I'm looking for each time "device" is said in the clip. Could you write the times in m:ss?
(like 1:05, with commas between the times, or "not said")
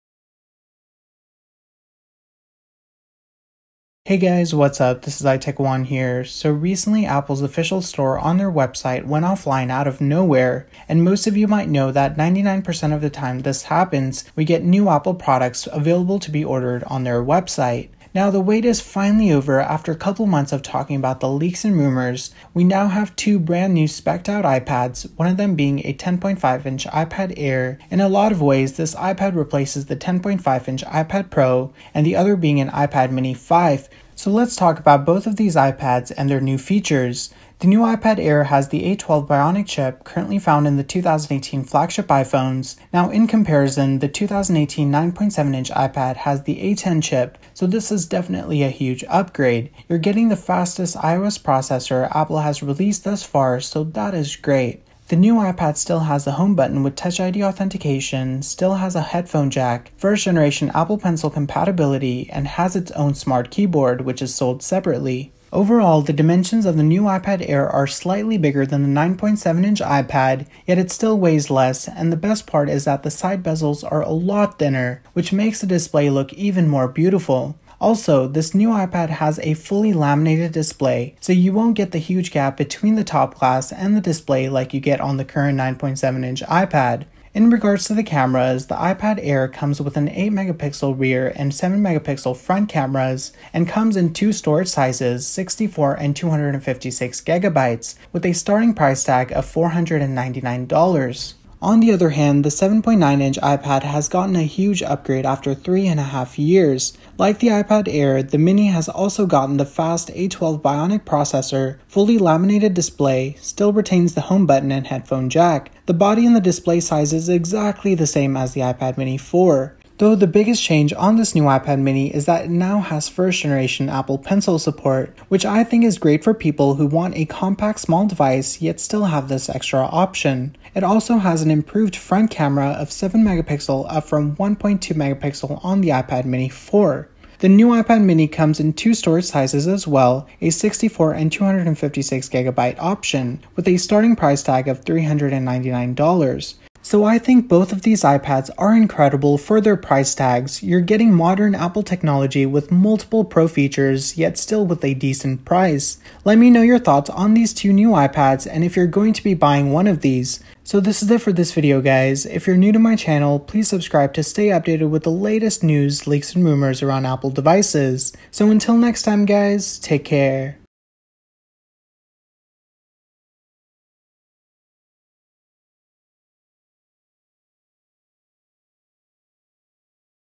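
2:08, 2:47.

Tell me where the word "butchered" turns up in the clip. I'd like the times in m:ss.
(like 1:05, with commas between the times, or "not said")
not said.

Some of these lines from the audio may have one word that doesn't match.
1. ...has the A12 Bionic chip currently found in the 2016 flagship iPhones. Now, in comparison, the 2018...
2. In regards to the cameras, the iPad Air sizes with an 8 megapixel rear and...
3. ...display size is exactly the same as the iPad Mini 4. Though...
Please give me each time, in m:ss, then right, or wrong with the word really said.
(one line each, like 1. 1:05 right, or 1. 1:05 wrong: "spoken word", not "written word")
1. 0:38 wrong: "2018", not "2016"
2. 1:27 wrong: "comes", not "sizes"
3. 1:56 right.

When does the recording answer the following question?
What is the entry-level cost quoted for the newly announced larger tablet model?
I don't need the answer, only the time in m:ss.
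1:39.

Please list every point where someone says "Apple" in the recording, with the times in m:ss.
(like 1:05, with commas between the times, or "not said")
0:07, 0:14, 0:52, 1:00, 2:03, 2:31, 2:47.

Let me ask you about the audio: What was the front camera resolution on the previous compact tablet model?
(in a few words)
1.2 megapixel.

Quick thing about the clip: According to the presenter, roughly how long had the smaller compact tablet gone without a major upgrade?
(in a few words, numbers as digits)
3.5 years.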